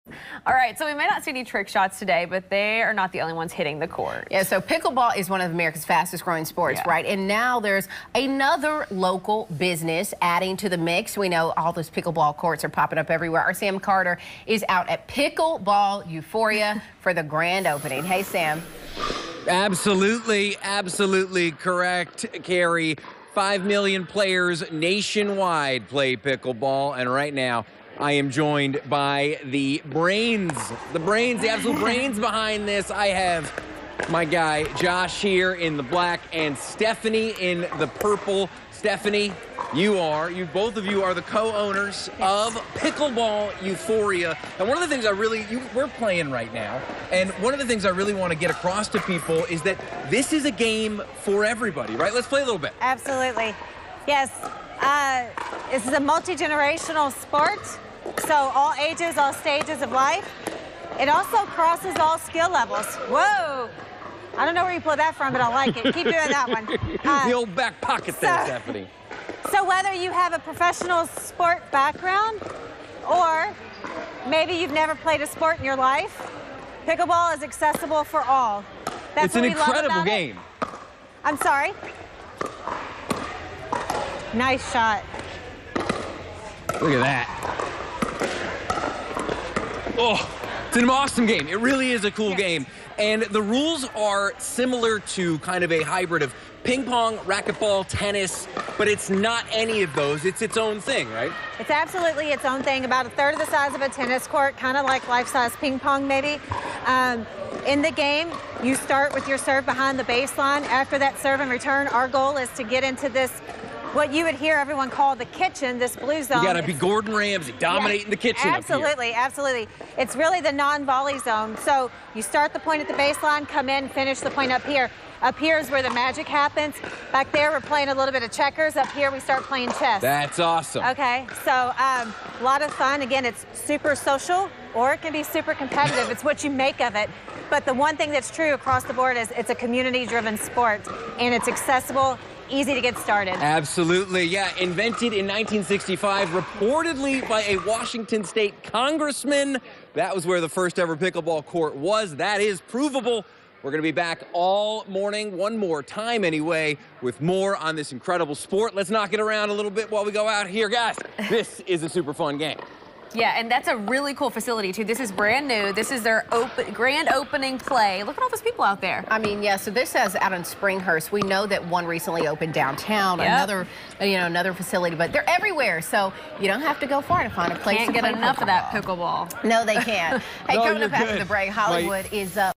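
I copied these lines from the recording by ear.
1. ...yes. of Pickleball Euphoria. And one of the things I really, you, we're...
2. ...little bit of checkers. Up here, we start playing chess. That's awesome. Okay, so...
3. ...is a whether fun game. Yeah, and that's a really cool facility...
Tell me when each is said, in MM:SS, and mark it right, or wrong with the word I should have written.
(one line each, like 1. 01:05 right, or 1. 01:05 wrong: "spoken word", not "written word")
1. 00:42 right
2. 02:07 right
3. 02:41 wrong: "super", not "whether".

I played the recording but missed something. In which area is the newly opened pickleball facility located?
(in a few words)
Springhurst.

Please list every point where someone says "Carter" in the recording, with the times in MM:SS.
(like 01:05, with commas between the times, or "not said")
00:13.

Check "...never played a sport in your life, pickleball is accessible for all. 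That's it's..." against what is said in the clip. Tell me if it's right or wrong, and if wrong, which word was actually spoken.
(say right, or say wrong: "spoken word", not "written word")
right.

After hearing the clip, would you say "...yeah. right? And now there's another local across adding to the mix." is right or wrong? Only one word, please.
wrong.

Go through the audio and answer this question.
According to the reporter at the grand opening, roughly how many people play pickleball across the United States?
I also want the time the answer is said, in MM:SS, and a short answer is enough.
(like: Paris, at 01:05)
5 million, at 00:23.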